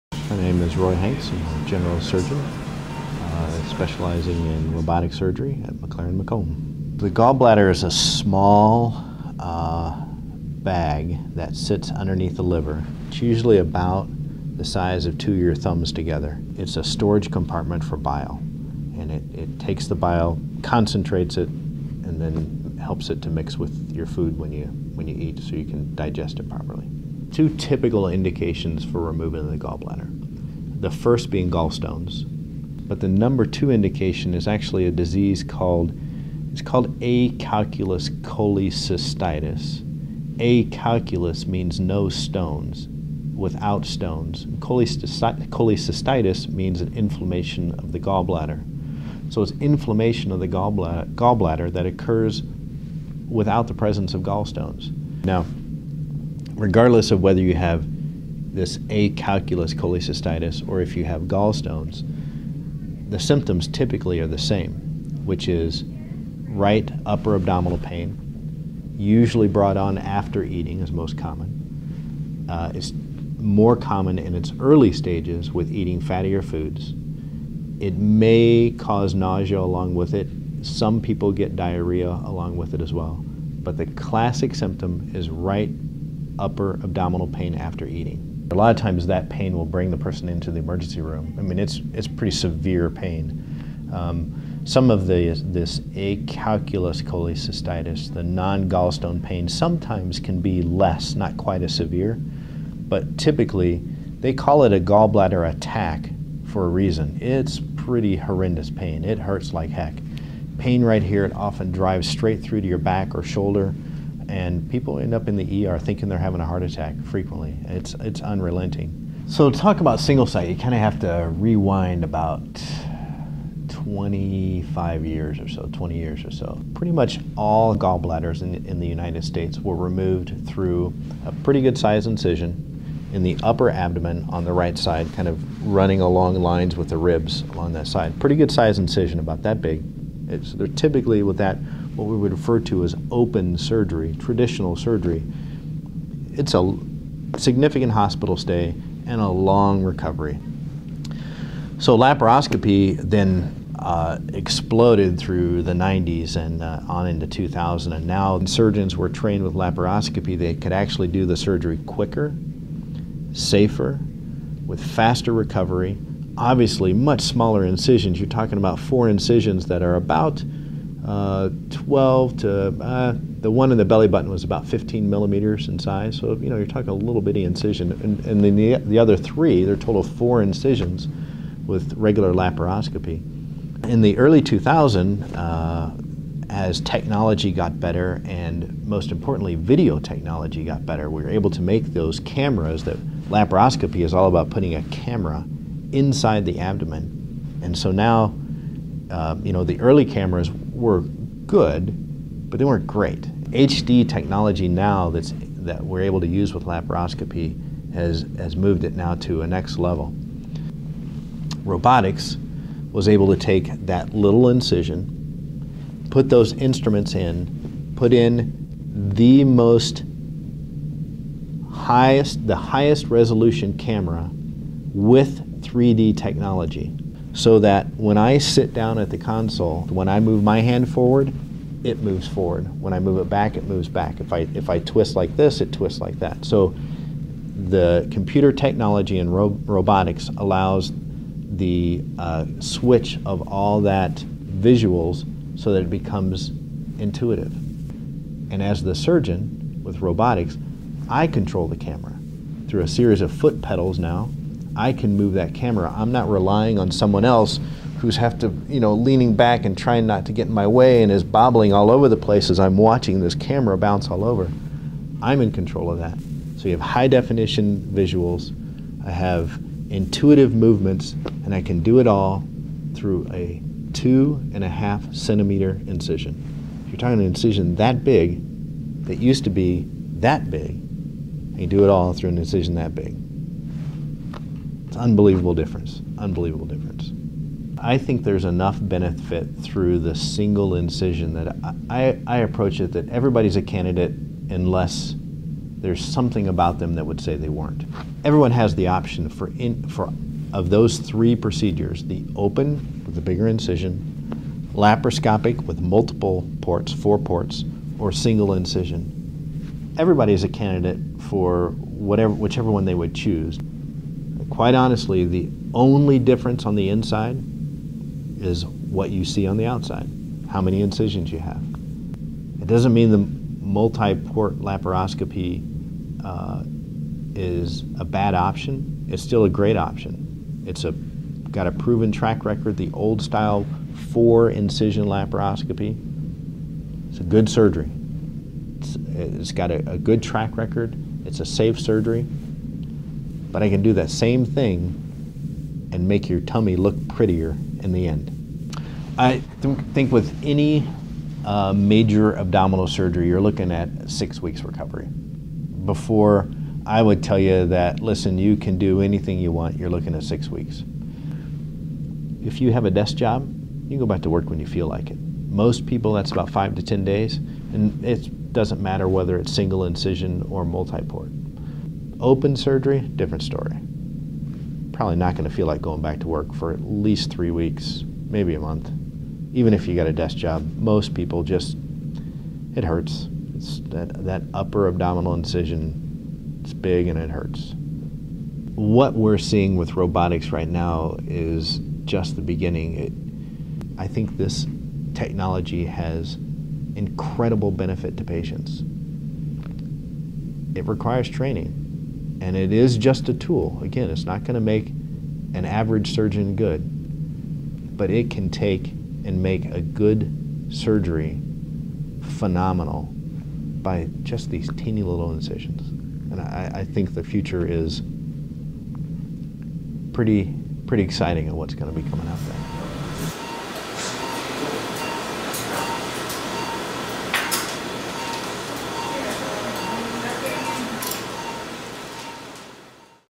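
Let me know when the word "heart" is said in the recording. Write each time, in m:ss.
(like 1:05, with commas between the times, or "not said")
1:56.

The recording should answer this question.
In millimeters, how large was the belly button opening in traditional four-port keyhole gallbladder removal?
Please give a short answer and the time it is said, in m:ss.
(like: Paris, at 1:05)
15, at 2:54.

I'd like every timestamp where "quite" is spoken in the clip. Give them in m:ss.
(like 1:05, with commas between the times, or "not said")
1:41, 5:14.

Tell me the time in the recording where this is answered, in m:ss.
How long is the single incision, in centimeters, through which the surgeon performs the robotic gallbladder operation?
4:33.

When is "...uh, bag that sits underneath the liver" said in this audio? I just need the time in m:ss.
0:09.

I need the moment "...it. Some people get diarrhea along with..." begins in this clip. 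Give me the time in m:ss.
1:20.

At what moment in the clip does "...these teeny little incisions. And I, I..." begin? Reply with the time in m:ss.
6:54.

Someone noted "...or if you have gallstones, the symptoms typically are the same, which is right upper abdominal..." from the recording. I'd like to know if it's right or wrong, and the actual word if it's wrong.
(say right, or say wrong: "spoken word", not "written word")
right.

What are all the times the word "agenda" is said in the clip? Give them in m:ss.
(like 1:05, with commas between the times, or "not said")
not said.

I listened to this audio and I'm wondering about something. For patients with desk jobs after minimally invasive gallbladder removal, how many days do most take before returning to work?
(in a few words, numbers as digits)
5 to 10 days.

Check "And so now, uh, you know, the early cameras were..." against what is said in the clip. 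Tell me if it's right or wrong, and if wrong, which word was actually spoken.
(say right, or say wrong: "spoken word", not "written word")
right.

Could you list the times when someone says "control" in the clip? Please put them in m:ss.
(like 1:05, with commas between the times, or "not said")
4:11, 4:25.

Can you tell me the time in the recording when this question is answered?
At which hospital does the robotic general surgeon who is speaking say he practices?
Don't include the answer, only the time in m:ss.
0:05.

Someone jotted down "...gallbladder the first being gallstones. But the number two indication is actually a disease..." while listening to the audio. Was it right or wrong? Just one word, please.
right.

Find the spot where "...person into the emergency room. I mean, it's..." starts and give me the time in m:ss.
1:29.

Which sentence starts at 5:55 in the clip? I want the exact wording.
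Before I would tell you that, listen, you can do anything you want, you're looking at six weeks.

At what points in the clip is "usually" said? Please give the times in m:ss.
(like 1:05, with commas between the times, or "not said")
0:13, 1:08.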